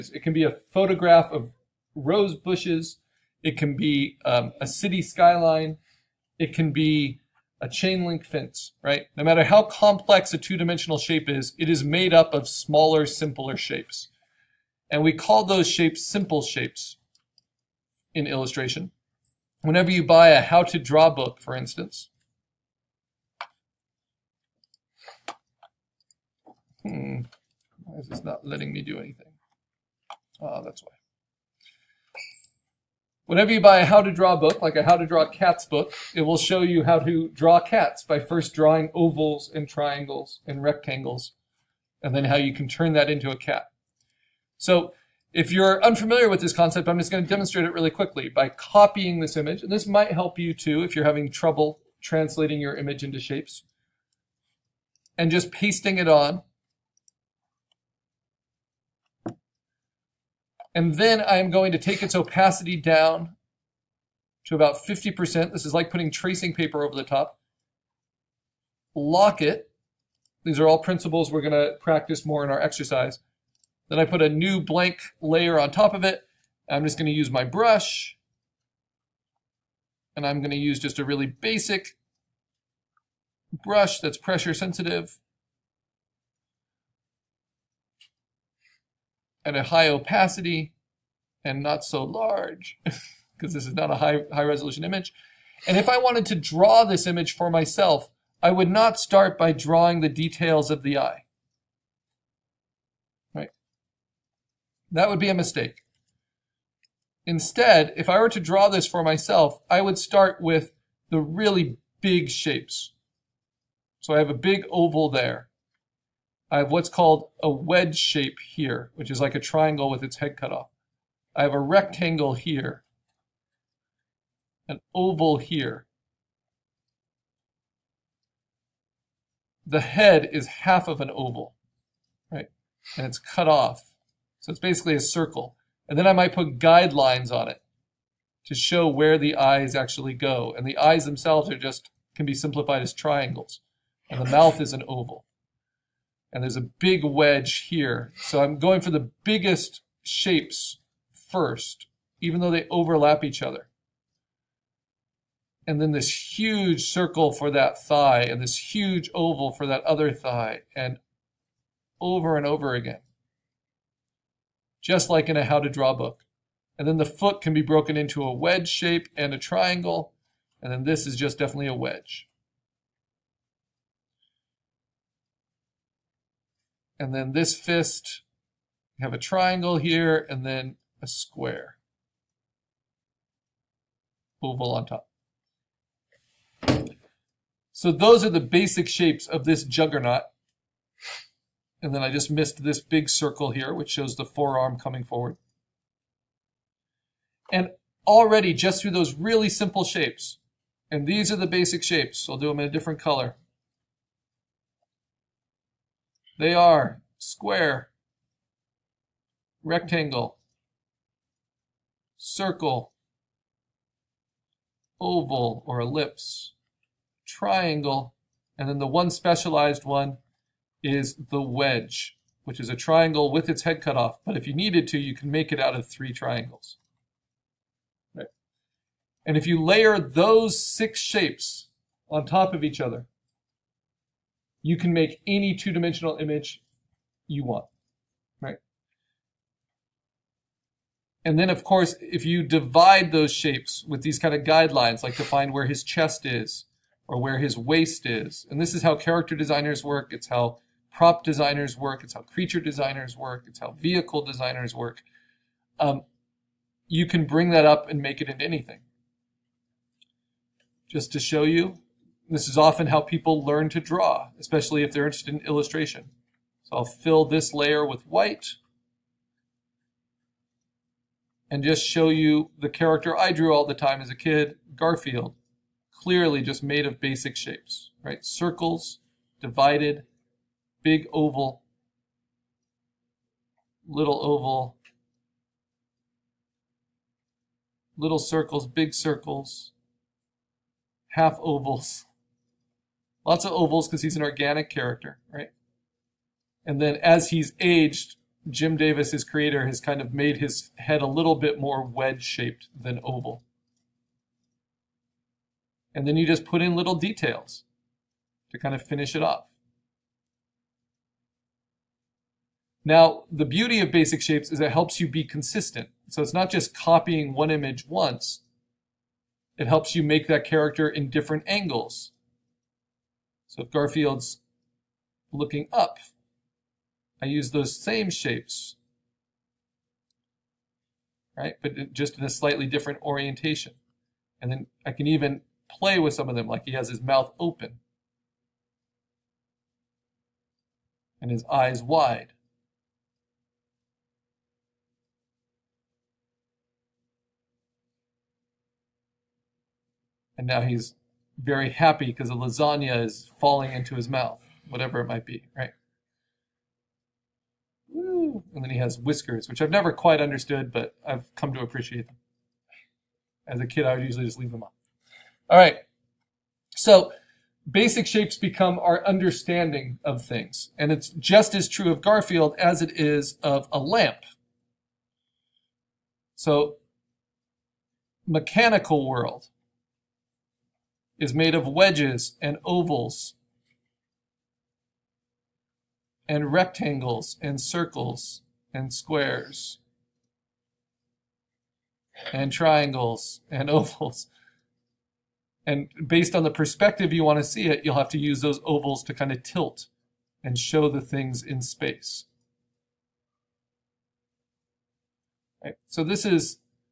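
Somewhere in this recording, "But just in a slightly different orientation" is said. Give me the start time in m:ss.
5:31.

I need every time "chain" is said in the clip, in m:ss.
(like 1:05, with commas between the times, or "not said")
0:07.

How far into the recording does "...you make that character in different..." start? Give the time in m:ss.
5:19.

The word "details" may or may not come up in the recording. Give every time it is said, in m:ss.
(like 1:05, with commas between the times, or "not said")
1:40, 5:06.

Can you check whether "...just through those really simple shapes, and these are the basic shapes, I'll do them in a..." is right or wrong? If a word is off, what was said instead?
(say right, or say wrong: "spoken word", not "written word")
right.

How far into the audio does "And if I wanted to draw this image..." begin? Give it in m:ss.
1:35.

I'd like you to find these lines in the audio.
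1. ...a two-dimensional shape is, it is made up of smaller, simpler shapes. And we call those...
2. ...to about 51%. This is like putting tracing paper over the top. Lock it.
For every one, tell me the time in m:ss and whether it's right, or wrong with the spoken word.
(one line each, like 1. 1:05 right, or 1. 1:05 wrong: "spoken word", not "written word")
1. 0:10 right
2. 1:04 wrong: "50", not "51".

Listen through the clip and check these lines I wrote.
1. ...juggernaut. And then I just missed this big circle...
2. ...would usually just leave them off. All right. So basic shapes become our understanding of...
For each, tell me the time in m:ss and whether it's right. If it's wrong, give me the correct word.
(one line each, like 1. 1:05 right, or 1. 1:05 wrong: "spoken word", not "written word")
1. 3:09 right
2. 6:03 right.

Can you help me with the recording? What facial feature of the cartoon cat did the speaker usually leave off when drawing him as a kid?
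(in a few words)
whiskers.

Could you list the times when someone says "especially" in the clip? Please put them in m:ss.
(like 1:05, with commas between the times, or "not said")
4:24.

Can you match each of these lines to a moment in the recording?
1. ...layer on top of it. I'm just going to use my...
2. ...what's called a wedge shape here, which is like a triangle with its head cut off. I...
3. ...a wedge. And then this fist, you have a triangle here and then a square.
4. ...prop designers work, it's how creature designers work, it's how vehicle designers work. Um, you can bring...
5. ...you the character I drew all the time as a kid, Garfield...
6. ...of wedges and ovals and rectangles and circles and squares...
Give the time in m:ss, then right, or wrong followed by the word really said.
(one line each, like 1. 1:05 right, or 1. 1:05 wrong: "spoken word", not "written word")
1. 1:15 right
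2. 1:56 right
3. 2:51 right
4. 4:10 right
5. 4:32 right
6. 6:21 right.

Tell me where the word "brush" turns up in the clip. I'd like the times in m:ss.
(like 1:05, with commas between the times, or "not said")
1:17, 1:23.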